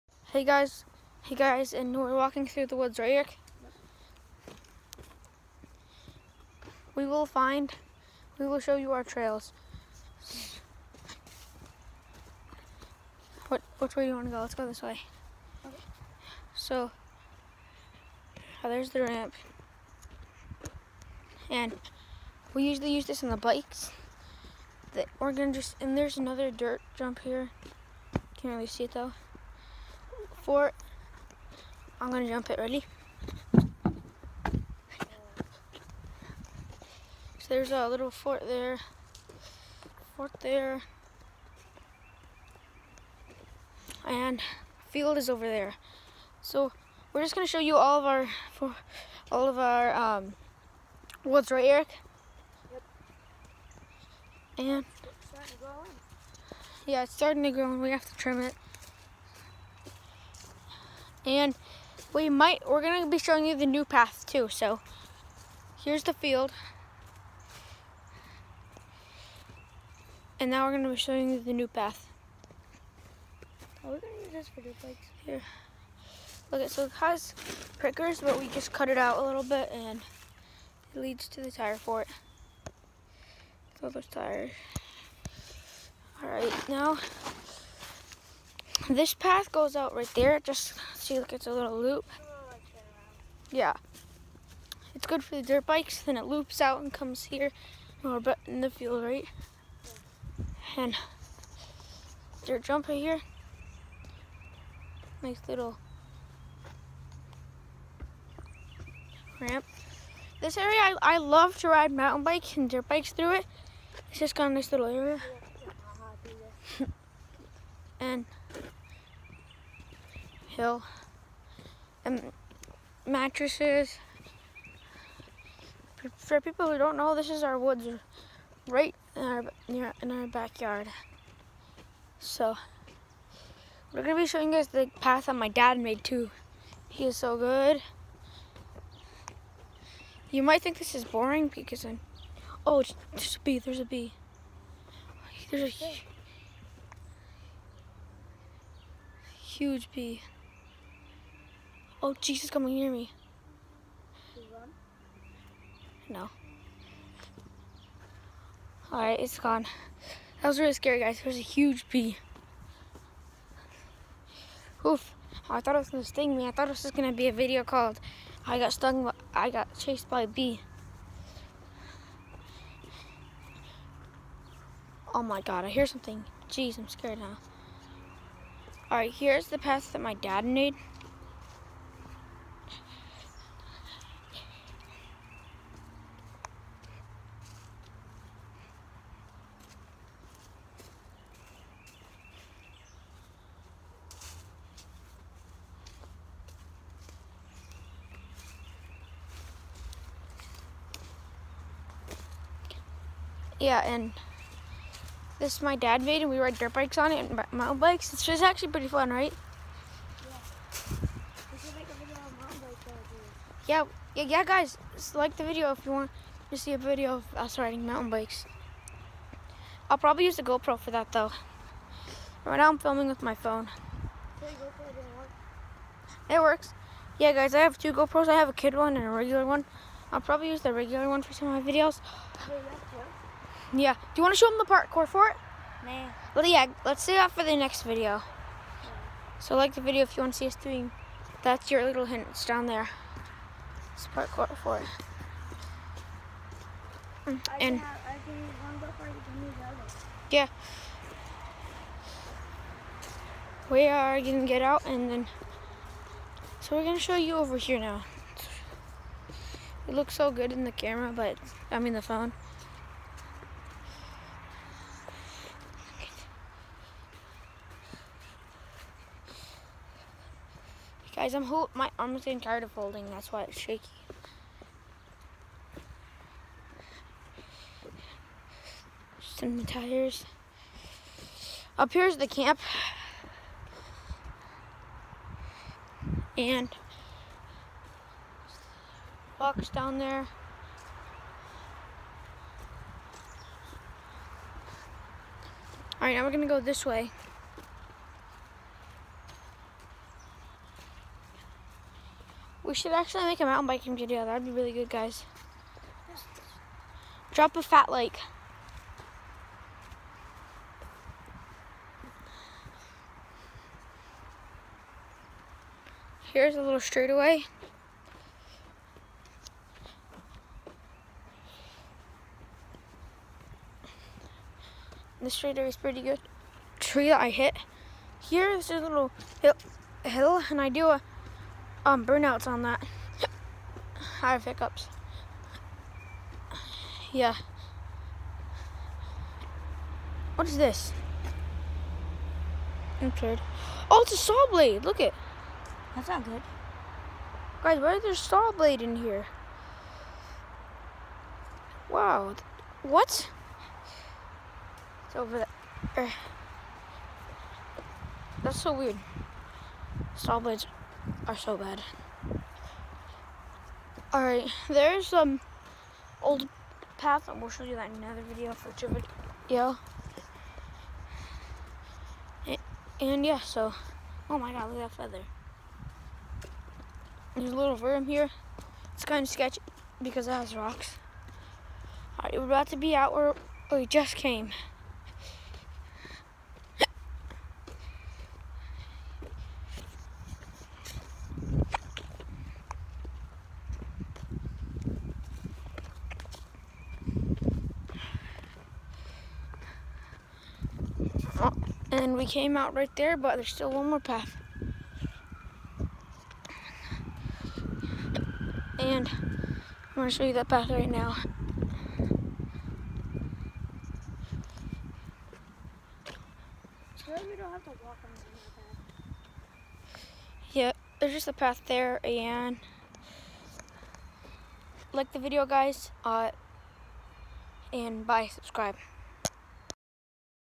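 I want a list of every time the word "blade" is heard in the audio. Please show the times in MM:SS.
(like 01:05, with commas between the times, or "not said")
05:44, 05:48, 06:00.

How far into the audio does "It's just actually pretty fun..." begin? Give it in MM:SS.
03:28.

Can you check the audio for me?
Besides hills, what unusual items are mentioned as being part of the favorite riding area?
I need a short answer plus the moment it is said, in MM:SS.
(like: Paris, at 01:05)
Mattresses, at 02:03.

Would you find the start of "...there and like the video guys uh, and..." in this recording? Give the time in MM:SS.
07:01.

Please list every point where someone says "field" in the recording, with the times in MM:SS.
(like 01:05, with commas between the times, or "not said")
00:44, 01:06, 01:38.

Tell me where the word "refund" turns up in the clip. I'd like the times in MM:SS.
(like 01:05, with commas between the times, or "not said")
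not said.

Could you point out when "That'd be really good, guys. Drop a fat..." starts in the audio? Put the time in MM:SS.
05:04.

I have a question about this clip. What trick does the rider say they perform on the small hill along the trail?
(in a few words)
Burnouts.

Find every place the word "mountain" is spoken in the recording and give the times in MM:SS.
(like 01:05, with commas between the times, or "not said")
01:51, 03:27, 03:37, 05:03.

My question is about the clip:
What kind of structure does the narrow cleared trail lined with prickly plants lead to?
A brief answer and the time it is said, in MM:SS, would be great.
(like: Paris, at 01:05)
Tire fort, at 01:21.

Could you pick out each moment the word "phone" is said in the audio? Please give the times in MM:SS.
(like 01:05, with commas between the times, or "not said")
03:43, 04:22.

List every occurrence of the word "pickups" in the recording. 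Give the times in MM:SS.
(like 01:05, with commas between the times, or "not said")
05:34.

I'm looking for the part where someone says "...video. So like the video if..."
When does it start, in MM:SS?
03:57.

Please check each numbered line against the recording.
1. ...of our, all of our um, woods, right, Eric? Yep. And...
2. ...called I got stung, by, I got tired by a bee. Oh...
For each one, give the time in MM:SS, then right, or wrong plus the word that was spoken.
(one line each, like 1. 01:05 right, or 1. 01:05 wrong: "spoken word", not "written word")
1. 00:47 right
2. 02:47 wrong: "chased", not "tired".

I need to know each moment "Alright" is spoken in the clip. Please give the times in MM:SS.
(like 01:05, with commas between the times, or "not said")
02:38, 02:58, 06:04, 06:22.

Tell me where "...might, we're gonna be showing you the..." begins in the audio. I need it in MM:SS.
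01:02.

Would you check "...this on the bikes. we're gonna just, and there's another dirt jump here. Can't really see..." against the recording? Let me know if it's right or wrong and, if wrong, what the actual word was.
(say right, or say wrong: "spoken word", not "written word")
right.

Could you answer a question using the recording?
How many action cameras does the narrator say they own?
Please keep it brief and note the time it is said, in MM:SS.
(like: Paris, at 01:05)
2, at 03:47.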